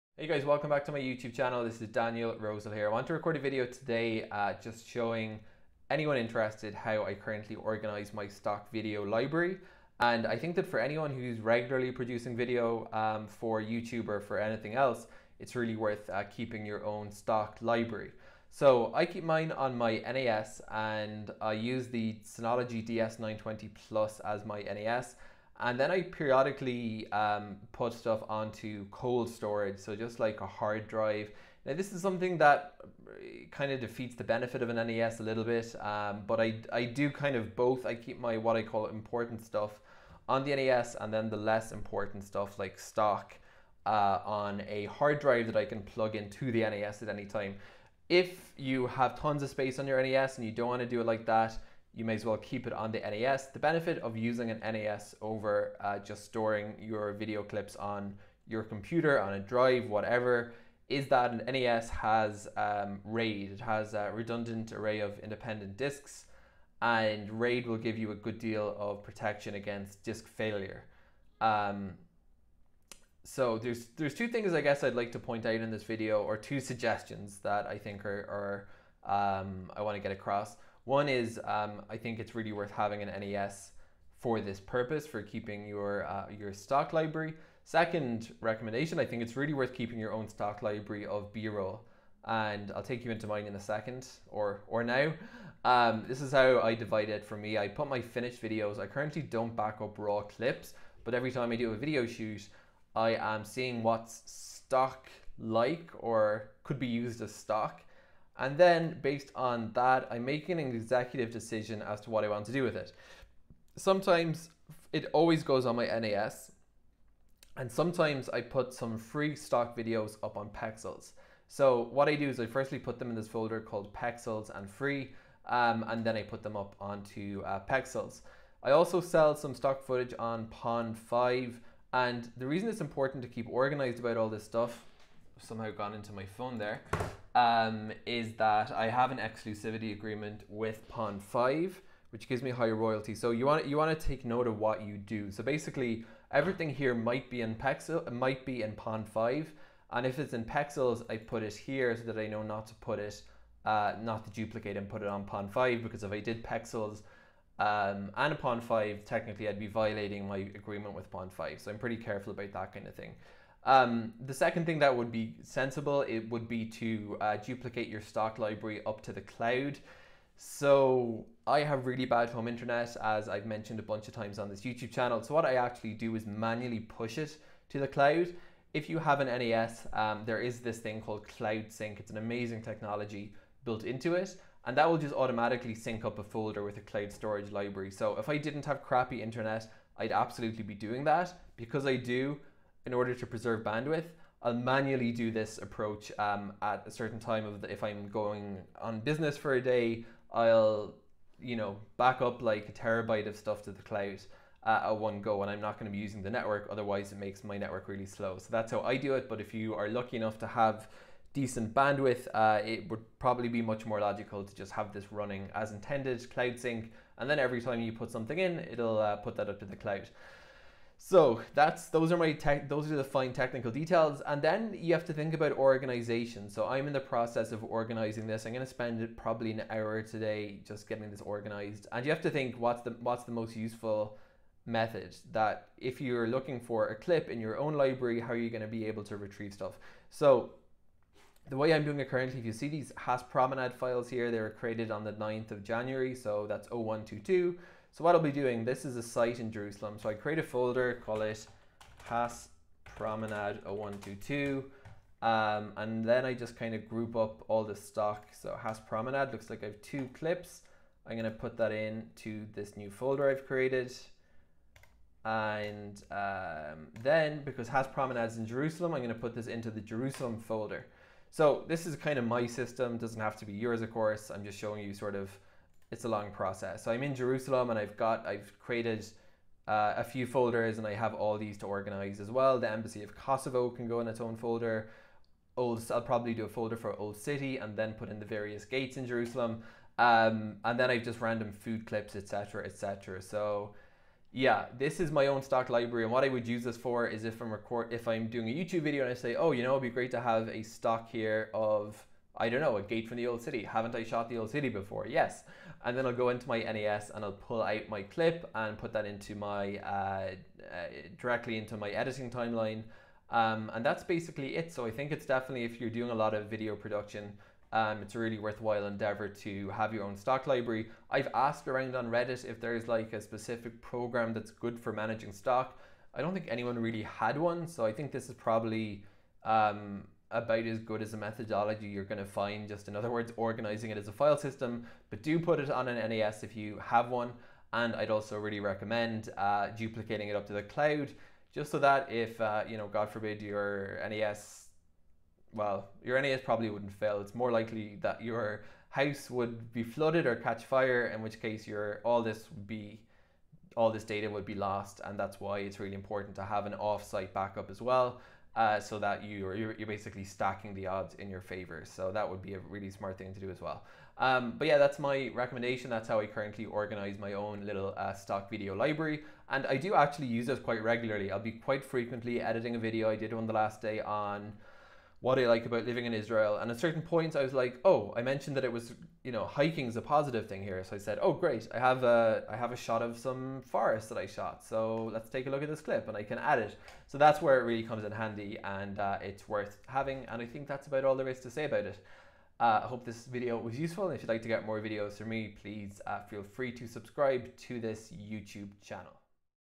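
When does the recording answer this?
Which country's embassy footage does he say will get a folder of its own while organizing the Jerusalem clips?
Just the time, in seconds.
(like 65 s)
283 s.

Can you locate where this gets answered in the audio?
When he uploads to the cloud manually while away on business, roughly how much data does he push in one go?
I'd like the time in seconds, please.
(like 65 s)
202 s.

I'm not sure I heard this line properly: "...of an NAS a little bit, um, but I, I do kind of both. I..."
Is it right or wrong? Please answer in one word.
right.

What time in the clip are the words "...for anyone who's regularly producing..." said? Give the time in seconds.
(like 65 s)
10 s.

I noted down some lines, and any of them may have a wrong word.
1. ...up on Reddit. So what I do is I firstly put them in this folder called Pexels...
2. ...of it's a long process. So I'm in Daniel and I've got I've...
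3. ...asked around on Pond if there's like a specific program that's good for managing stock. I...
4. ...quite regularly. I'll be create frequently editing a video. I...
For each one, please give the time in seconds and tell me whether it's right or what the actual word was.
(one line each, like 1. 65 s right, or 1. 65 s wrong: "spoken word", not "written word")
1. 120 s wrong: "Pexels", not "Reddit"
2. 275 s wrong: "Jerusalem", not "Daniel"
3. 321 s wrong: "Reddit", not "Pond"
4. 370 s wrong: "quite", not "create".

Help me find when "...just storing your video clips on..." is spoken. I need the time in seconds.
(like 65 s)
55 s.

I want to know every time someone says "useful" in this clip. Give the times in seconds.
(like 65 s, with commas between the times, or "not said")
233 s, 393 s.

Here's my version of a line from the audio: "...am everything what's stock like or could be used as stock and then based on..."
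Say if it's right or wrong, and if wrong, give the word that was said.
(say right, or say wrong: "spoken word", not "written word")
wrong: "seeing", not "everything".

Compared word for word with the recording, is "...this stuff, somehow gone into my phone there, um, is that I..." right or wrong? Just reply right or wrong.
right.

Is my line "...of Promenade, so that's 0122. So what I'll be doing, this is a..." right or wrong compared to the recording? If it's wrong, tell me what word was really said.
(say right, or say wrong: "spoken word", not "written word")
wrong: "January", not "Promenade".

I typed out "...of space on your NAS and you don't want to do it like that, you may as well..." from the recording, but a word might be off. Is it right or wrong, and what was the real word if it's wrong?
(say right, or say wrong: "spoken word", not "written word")
right.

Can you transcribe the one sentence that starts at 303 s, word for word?
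Haven't I shot the old city before?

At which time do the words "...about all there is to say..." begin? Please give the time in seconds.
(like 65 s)
390 s.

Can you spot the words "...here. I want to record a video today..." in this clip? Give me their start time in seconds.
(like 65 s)
2 s.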